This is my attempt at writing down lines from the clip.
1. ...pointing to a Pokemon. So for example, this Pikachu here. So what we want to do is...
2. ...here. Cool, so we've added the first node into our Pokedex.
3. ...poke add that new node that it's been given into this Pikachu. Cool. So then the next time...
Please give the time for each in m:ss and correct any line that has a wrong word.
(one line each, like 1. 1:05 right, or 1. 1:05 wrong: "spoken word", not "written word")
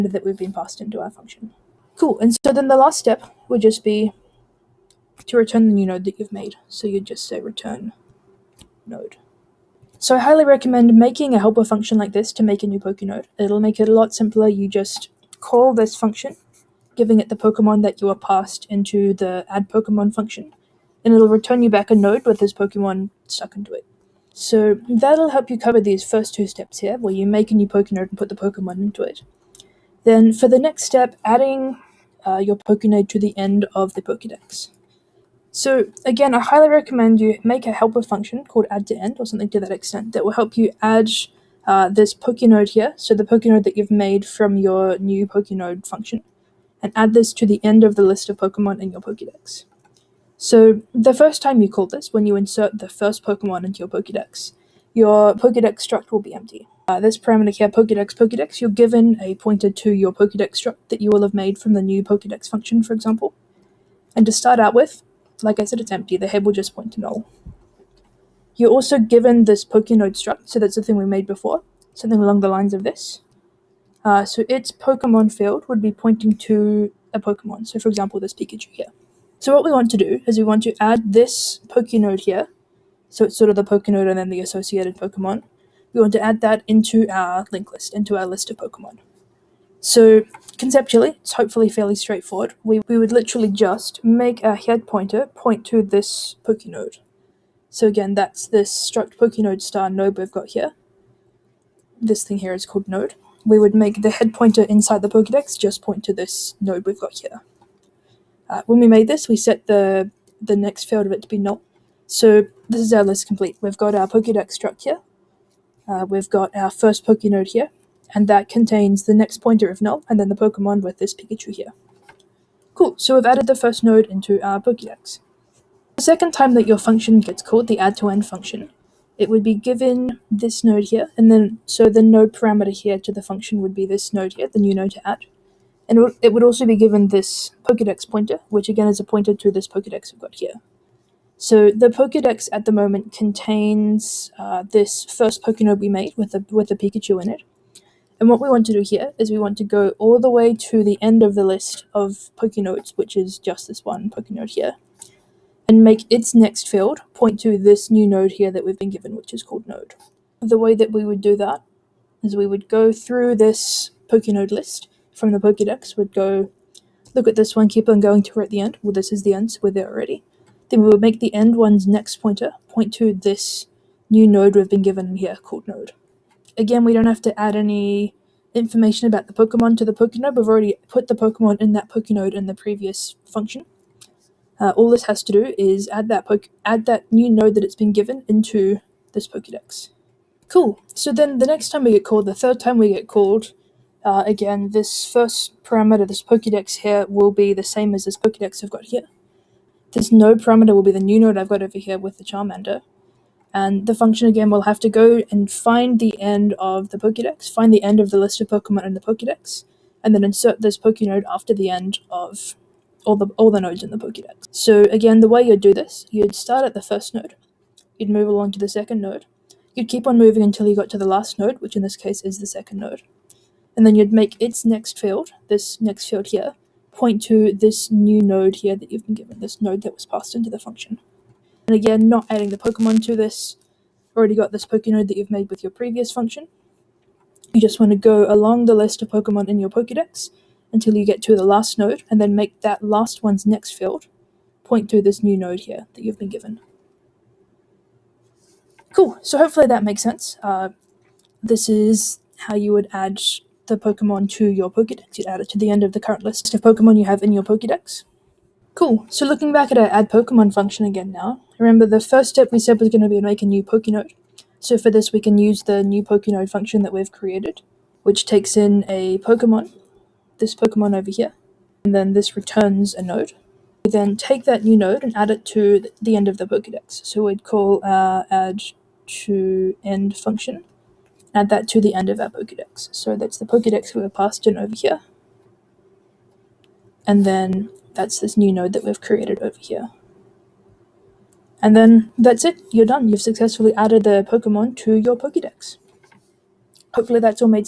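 1. 1:15 right
2. 2:01 right
3. 3:06 wrong: "Pokedex", not "Pikachu".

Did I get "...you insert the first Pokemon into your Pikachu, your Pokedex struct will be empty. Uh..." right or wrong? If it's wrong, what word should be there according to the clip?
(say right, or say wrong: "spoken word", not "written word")
wrong: "Pokedex", not "Pikachu".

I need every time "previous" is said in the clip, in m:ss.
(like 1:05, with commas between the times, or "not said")
3:02, 3:55.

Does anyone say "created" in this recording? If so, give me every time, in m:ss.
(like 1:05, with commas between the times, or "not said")
4:27, 4:49.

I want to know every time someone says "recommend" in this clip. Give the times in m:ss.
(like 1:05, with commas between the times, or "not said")
0:10, 0:36.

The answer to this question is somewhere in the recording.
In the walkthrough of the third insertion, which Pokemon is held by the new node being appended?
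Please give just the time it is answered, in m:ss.
3:22.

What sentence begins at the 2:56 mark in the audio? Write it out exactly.
Again, we don't have to add any information about the Pokemon to the Pokenode.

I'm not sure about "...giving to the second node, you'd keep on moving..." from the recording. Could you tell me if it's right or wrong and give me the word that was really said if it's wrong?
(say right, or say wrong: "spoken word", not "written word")
wrong: "along", not "giving".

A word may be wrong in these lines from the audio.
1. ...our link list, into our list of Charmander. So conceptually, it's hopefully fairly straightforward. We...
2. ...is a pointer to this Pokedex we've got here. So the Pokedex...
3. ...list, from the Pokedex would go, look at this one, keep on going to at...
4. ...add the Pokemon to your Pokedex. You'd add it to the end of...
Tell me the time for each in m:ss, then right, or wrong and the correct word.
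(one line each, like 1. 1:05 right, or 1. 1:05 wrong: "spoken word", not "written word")
1. 1:27 wrong: "Pokemon", not "Charmander"
2. 2:18 right
3. 2:44 right
4. 4:12 right.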